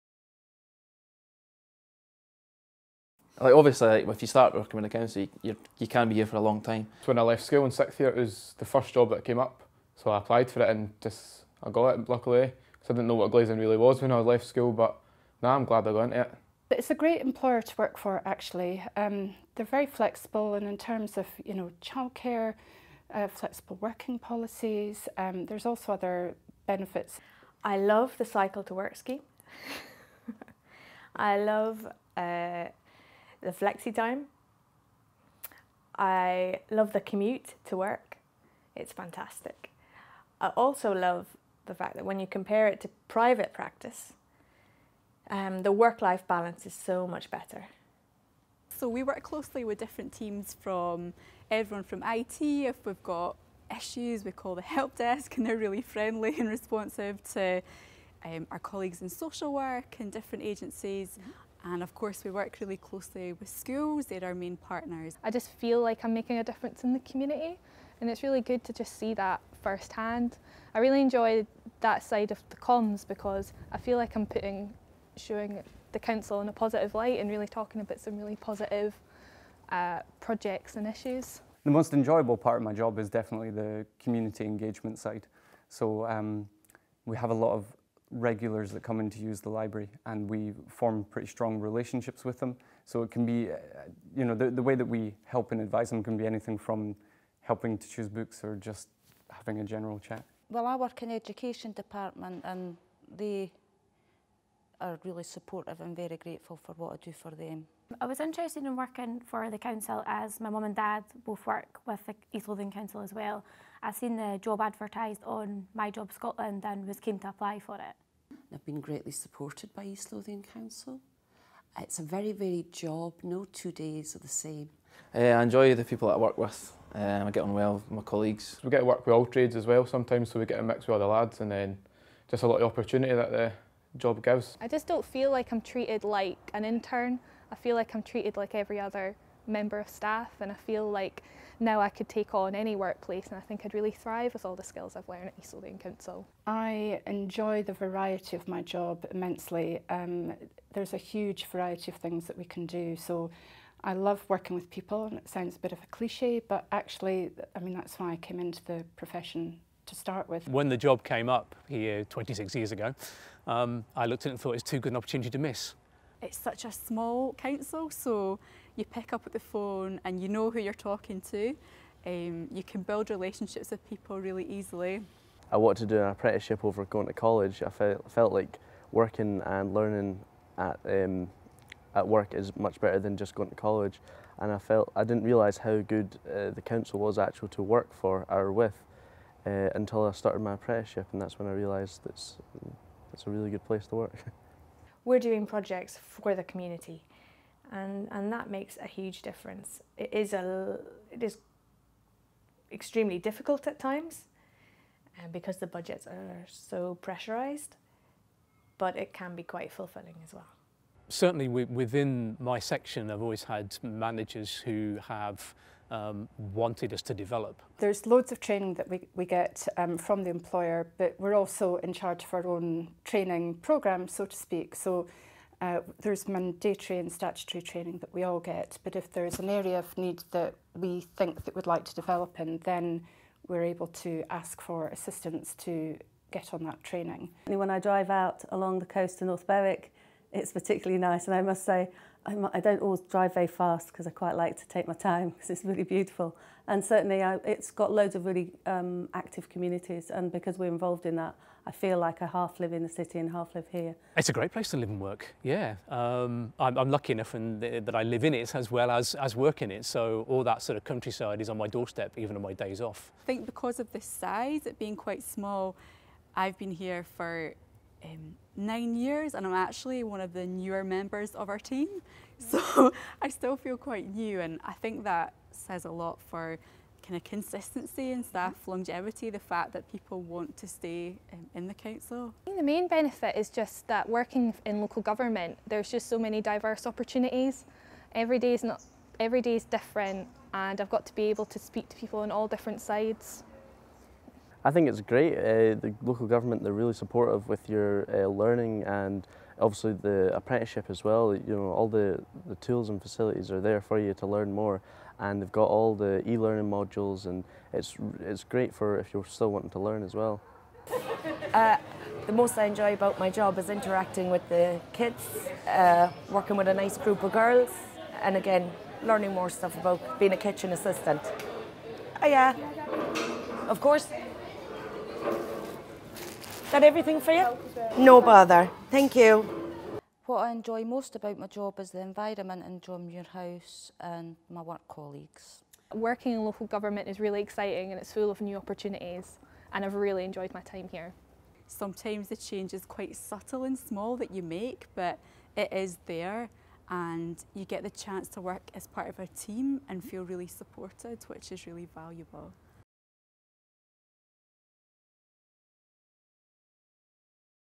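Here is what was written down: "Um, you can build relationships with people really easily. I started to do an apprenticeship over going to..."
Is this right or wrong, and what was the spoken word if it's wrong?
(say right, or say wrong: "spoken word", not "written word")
wrong: "wanted", not "started".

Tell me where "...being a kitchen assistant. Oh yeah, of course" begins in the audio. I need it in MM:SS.
05:20.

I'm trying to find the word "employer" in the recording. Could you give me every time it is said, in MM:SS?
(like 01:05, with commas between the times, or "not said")
00:17, 03:40.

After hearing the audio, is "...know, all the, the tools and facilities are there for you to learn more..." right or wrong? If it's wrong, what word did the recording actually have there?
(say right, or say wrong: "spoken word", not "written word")
right.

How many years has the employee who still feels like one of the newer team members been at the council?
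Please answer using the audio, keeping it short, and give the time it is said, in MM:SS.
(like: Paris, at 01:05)
9, at 04:28.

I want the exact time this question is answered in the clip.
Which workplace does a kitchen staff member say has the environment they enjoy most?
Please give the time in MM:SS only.
05:32.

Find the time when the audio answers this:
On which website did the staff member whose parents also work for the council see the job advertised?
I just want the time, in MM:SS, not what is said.
01:55.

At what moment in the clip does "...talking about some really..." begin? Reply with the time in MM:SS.
01:17.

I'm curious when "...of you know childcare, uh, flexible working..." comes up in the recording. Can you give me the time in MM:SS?
00:21.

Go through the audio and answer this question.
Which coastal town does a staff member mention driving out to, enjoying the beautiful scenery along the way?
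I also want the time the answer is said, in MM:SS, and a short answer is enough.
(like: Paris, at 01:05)
North Berwick, at 03:59.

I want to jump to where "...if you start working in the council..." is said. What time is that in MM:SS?
00:04.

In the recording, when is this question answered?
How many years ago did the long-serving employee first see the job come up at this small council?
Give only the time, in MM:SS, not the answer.
02:42.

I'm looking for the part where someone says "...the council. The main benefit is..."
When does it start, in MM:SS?
04:41.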